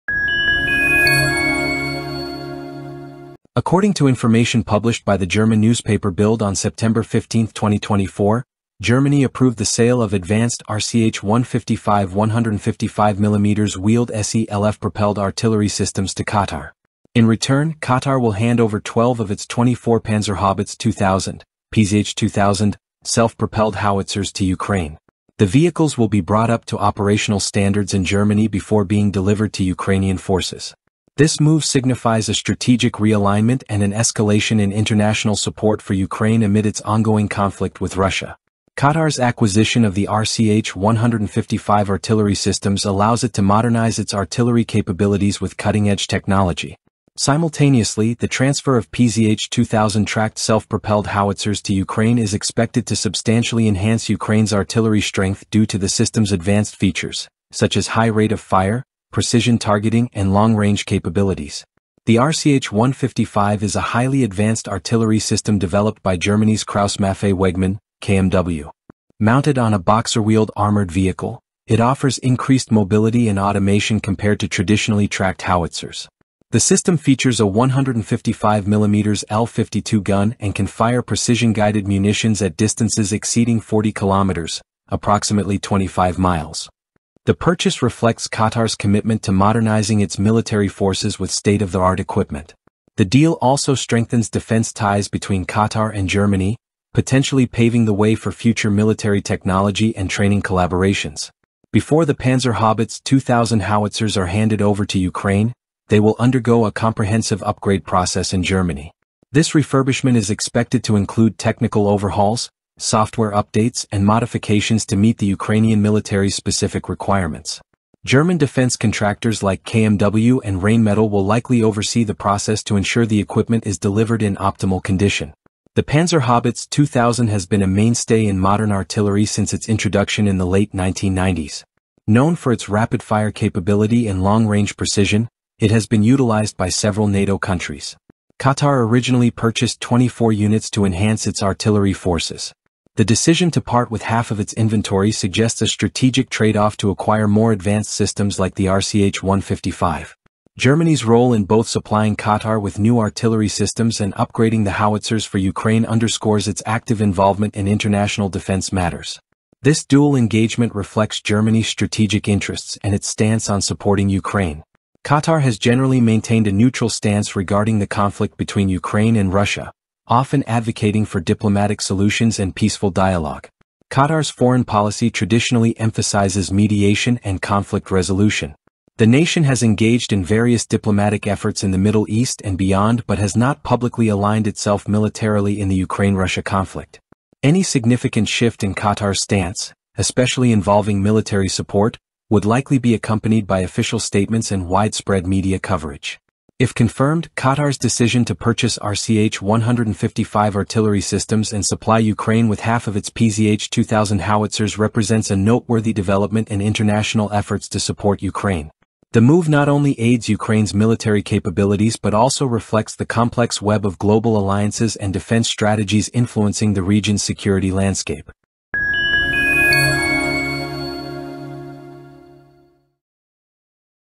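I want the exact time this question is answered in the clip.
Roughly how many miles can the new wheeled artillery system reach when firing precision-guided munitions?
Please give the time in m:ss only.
1:25.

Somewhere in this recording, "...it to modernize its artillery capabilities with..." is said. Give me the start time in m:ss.
0:43.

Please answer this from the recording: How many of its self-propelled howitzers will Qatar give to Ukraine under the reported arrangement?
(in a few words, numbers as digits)
12.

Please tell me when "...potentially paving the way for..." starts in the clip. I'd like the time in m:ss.
1:36.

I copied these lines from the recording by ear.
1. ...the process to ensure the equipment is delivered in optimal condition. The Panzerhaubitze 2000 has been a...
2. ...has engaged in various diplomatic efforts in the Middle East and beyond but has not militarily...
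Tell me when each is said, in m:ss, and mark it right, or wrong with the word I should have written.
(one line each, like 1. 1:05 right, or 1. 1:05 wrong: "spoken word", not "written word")
1. 2:02 right
2. 2:59 wrong: "publicly", not "militarily".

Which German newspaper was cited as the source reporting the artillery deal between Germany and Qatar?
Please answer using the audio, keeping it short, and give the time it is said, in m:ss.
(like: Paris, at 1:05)
Bild, at 0:06.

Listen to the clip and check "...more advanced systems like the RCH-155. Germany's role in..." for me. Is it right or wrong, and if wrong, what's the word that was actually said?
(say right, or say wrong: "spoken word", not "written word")
right.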